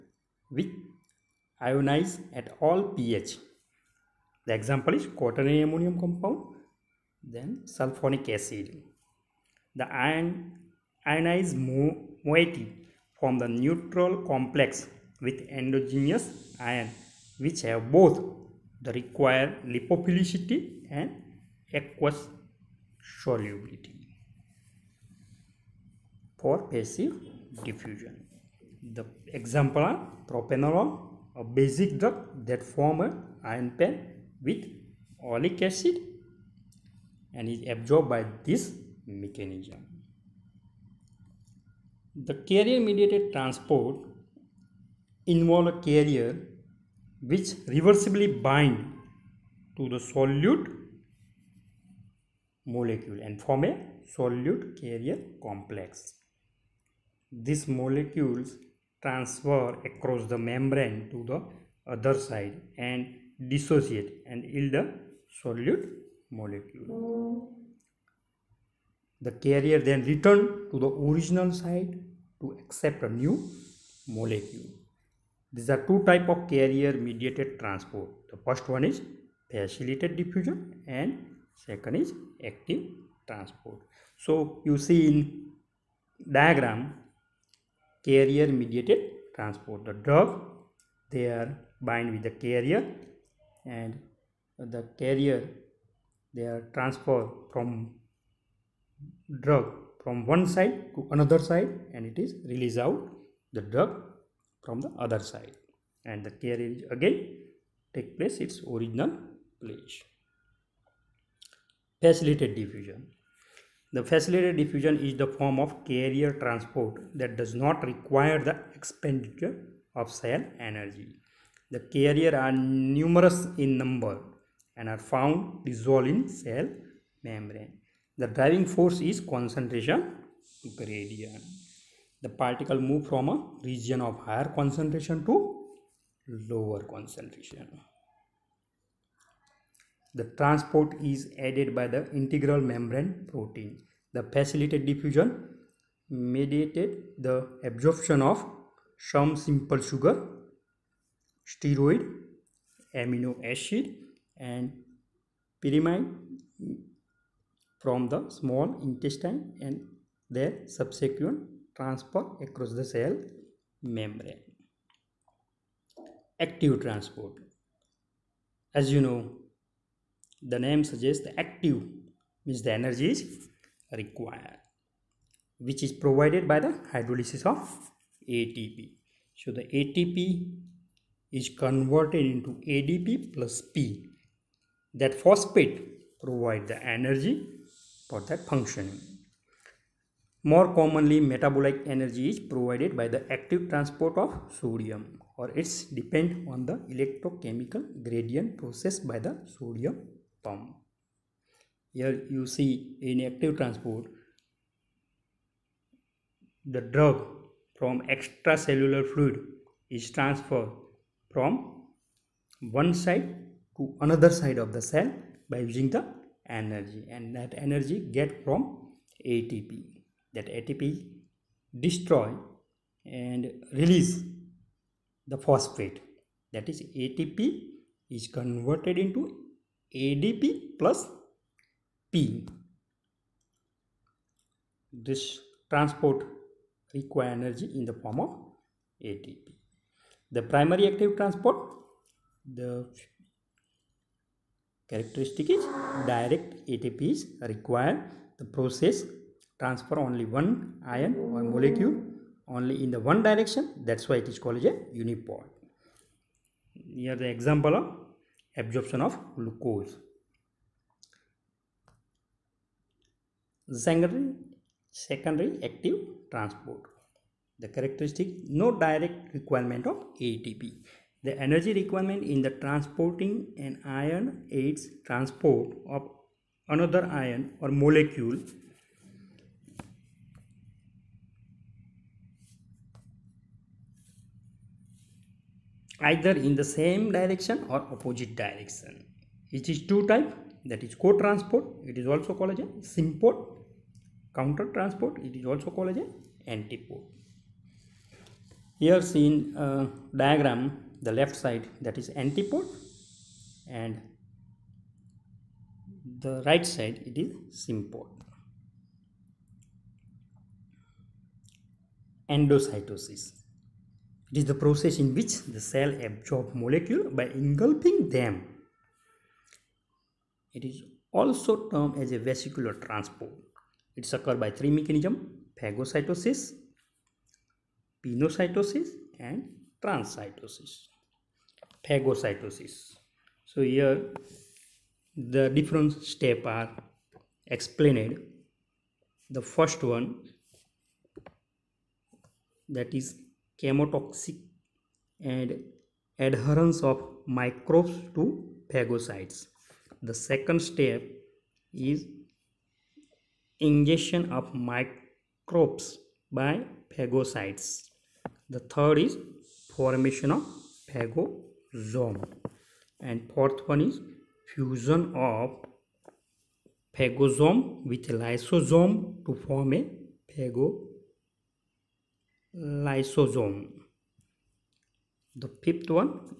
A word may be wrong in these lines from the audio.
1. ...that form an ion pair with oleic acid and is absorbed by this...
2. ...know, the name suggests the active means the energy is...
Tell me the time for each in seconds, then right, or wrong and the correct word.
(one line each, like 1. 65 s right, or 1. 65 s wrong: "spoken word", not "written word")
1. 32 s right
2. 169 s right.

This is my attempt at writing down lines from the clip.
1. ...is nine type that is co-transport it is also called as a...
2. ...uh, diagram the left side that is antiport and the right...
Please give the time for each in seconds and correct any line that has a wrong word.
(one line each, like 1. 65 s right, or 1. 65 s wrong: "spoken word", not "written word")
1. 289 s wrong: "two", not "nine"
2. 299 s right.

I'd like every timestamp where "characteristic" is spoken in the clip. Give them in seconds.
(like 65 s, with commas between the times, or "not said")
244 s, 267 s.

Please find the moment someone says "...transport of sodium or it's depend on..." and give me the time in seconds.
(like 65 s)
193 s.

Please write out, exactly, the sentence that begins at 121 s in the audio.
The carrier are numerous in number and are found dissolved in cell membrane.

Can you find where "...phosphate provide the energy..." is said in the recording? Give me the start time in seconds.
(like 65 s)
185 s.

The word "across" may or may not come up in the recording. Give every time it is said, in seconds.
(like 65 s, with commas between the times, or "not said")
59 s, 162 s.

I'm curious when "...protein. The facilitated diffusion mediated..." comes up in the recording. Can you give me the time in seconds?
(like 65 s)
143 s.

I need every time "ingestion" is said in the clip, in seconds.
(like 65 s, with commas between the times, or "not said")
353 s.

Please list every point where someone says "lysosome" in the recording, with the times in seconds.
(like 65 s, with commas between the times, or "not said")
368 s, 372 s.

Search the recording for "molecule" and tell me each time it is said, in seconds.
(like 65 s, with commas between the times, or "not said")
52 s, 57 s, 66 s, 74 s, 251 s, 277 s, 316 s.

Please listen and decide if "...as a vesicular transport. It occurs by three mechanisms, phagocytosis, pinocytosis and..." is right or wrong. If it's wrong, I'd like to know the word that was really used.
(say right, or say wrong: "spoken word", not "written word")
right.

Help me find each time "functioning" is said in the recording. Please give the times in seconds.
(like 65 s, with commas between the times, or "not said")
188 s.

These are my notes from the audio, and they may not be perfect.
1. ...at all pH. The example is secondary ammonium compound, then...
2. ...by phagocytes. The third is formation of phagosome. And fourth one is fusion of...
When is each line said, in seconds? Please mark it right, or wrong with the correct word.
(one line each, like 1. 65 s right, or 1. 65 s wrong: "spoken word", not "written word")
1. 2 s wrong: "quaternary", not "secondary"
2. 356 s right.